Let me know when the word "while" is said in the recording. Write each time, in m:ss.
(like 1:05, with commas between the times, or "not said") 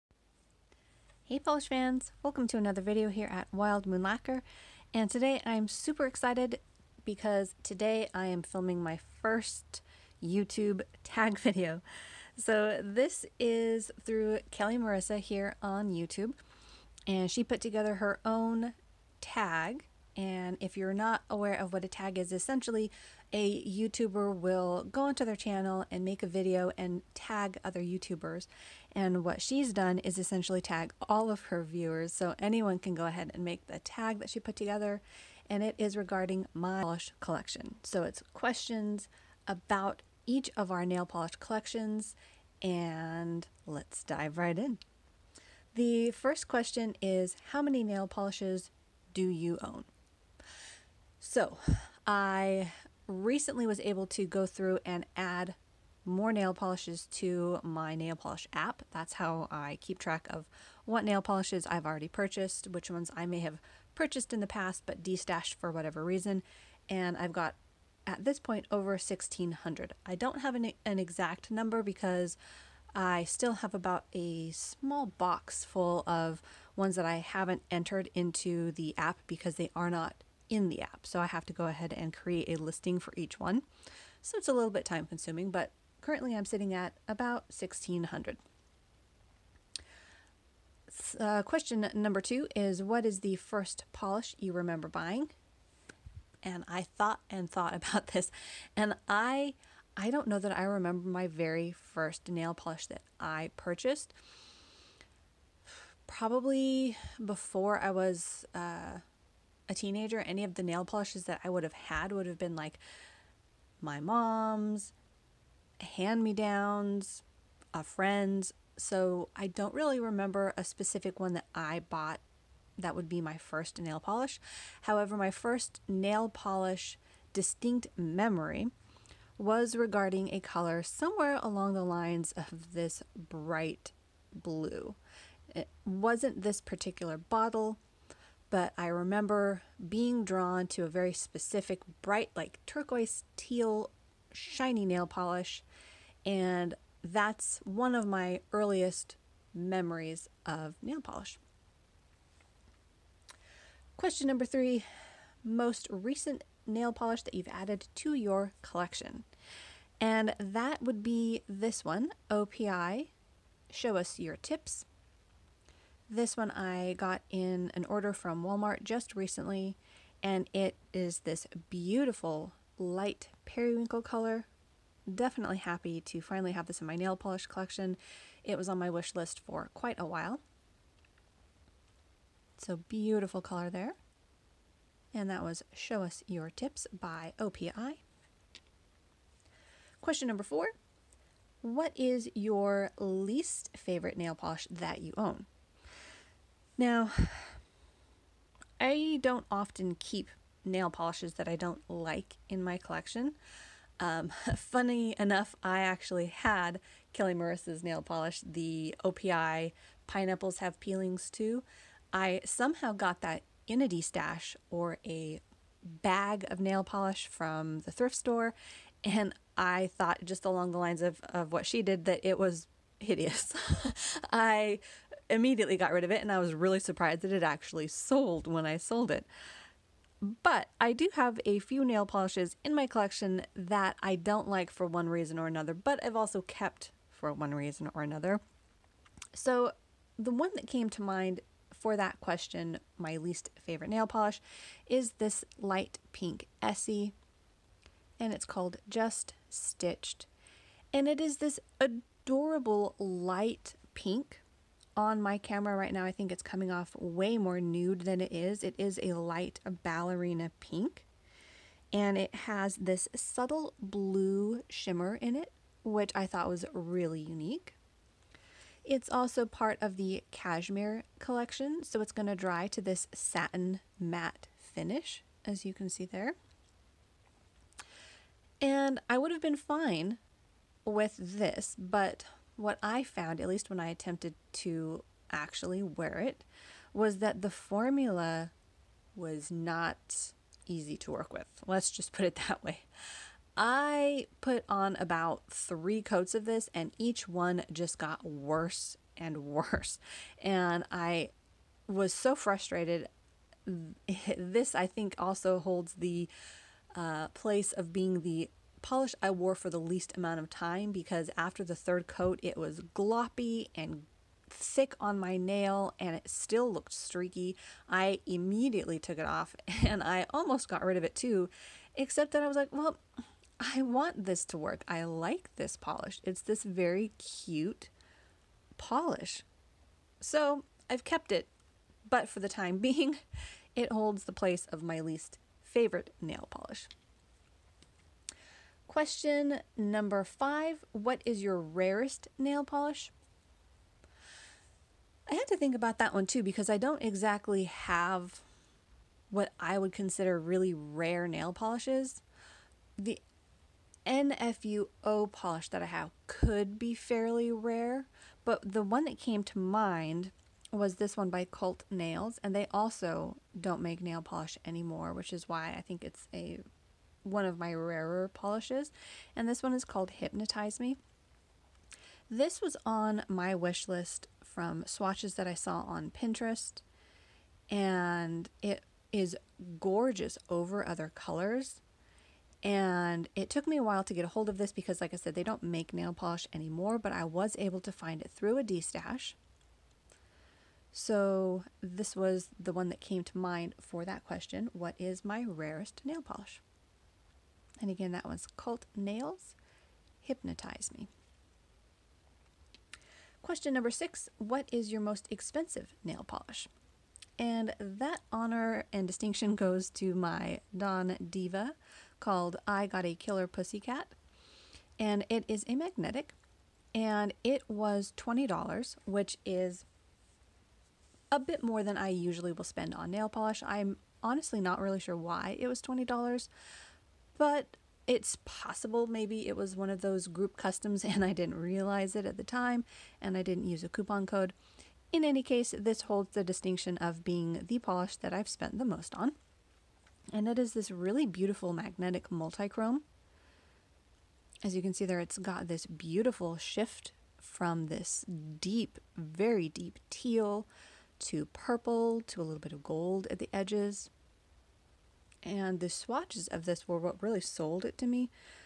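3:00, 6:23.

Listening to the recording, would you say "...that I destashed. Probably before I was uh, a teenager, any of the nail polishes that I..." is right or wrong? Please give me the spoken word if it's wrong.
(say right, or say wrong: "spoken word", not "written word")
wrong: "purchased", not "destashed".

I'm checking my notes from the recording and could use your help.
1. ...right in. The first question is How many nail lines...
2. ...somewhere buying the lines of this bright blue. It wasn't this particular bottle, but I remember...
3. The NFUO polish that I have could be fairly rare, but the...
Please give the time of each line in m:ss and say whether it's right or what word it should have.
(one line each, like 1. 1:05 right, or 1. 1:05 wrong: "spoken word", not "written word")
1. 0:44 wrong: "polishes", not "lines"
2. 2:10 wrong: "along", not "buying"
3. 5:52 right.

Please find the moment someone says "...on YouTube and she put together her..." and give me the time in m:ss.
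0:15.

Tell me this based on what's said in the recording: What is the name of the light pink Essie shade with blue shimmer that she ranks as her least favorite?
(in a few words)
Just Stitched.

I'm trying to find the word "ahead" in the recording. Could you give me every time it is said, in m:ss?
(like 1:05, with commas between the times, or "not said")
0:33, 1:21.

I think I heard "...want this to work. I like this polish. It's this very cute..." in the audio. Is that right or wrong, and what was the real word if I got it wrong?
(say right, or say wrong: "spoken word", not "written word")
right.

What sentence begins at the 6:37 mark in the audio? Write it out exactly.
And again, that one's Cult Nails, Hypnotize Me.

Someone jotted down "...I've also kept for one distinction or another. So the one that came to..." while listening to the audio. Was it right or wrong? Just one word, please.
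wrong.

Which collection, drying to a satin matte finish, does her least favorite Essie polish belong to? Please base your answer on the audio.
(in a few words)
cashmere collection.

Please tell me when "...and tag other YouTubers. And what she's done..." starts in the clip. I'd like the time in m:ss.
0:26.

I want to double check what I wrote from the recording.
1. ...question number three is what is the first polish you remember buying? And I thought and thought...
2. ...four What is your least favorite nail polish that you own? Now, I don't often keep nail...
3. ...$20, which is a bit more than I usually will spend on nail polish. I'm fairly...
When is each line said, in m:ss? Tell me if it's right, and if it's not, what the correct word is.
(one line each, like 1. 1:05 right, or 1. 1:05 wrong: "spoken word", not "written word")
1. 1:31 wrong: "two", not "three"
2. 3:10 right
3. 6:58 wrong: "honestly", not "fairly".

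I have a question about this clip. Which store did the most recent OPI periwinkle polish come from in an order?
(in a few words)
Walmart.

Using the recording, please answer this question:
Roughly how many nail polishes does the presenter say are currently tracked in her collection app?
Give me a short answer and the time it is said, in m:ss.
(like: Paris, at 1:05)
1600, at 1:08.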